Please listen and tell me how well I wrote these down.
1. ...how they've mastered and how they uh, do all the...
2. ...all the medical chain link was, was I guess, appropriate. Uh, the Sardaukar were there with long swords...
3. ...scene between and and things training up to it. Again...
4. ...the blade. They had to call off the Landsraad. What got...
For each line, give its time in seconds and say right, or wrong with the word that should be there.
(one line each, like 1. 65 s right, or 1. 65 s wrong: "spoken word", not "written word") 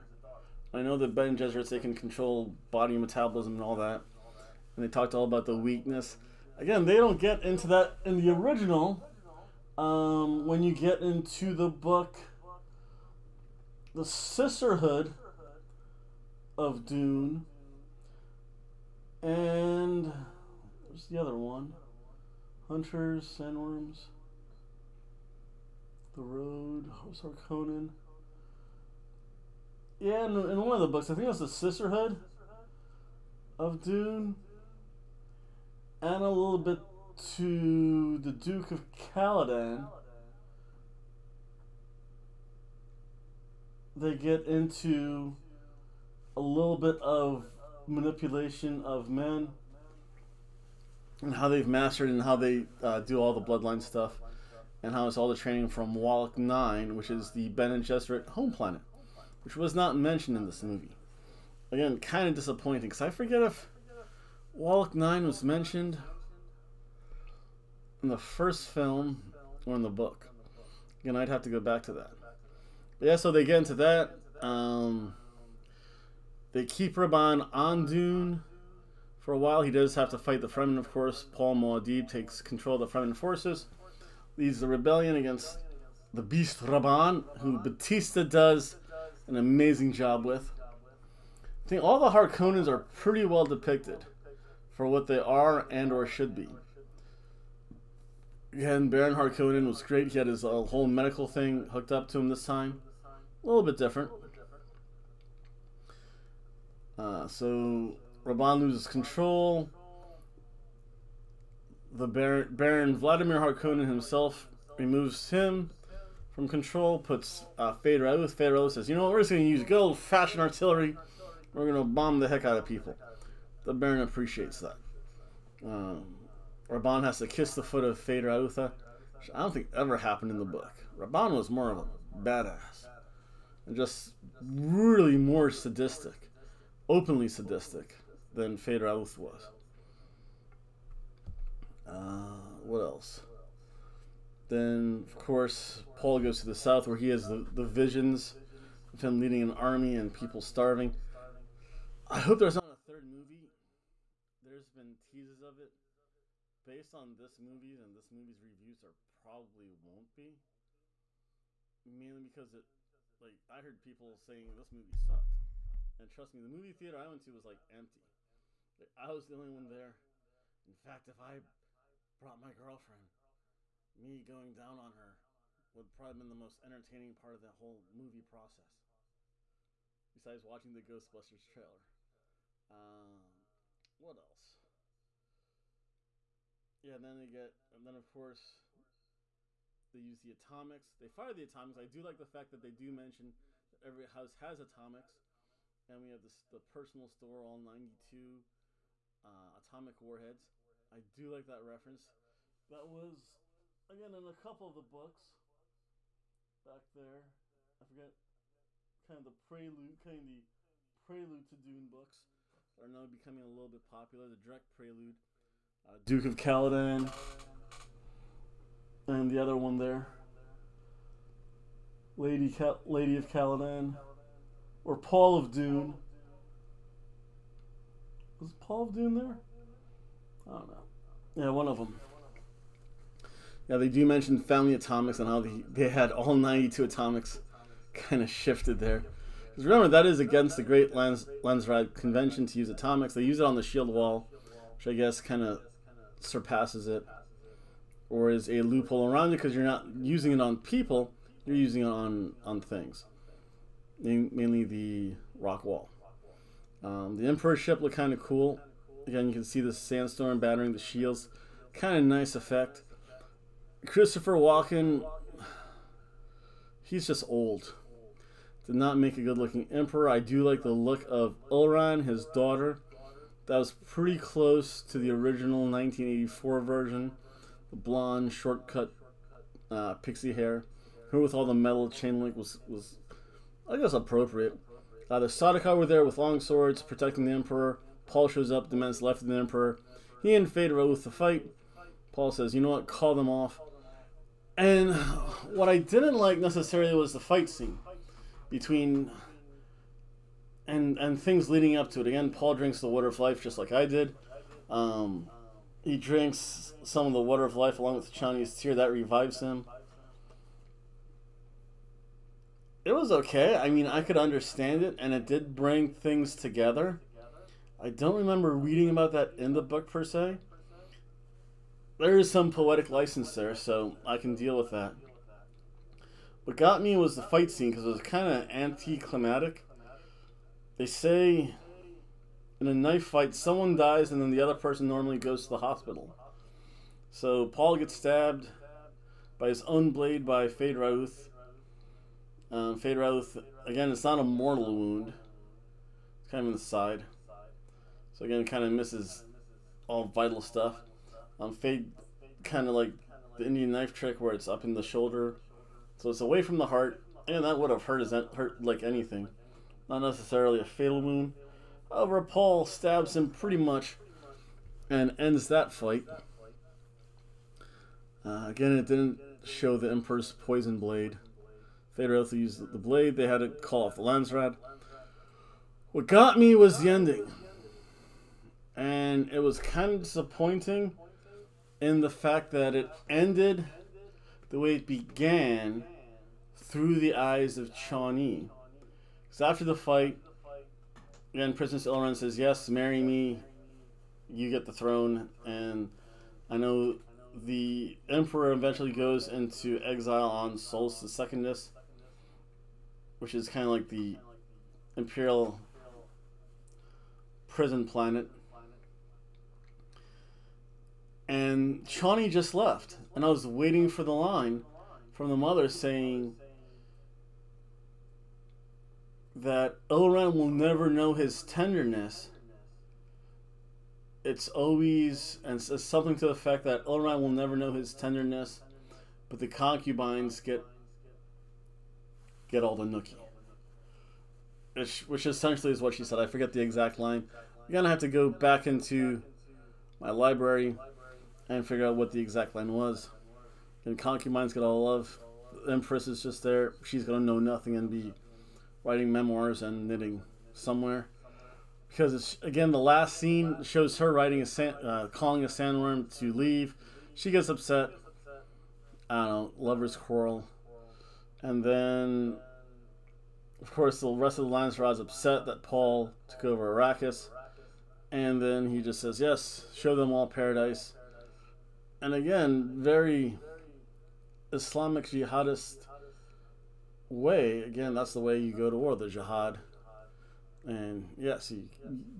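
1. 51 s right
2. 281 s wrong: "metal", not "medical"
3. 297 s wrong: "leading", not "training"
4. 372 s right.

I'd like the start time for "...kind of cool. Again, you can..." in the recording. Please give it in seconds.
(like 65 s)
257 s.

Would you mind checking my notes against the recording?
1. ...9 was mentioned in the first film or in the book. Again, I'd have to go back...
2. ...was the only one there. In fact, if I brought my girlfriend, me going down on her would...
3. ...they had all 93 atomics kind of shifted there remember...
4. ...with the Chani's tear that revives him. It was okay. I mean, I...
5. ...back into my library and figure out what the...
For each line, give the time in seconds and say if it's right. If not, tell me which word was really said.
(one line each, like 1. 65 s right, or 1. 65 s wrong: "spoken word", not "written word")
1. 64 s right
2. 169 s right
3. 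235 s wrong: "92", not "93"
4. 307 s right
5. 438 s right.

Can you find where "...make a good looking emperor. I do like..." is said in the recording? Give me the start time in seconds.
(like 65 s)
268 s.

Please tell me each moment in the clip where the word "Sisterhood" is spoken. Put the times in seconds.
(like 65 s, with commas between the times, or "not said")
14 s, 31 s.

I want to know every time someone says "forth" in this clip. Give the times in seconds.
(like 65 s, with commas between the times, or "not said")
not said.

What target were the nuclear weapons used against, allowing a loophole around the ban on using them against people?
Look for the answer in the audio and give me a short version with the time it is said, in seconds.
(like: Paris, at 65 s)
the shield wall, at 243 s.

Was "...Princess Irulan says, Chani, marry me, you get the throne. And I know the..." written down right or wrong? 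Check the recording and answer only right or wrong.
wrong.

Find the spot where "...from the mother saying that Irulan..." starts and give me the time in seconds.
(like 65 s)
415 s.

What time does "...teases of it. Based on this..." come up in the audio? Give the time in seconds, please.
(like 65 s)
154 s.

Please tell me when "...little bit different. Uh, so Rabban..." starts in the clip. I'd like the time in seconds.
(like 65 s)
103 s.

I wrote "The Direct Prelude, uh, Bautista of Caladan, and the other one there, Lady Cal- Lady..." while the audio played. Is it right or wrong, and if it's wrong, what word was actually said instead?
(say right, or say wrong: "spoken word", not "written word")
wrong: "Duke", not "Bautista".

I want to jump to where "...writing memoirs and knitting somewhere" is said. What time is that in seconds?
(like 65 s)
448 s.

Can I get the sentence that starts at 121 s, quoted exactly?
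We're going to bomb the heck out of people the Baron appreciates that.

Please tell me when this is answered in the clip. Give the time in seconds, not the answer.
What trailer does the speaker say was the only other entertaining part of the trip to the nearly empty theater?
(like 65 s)
180 s.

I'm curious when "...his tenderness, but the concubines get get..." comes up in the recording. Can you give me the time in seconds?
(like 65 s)
427 s.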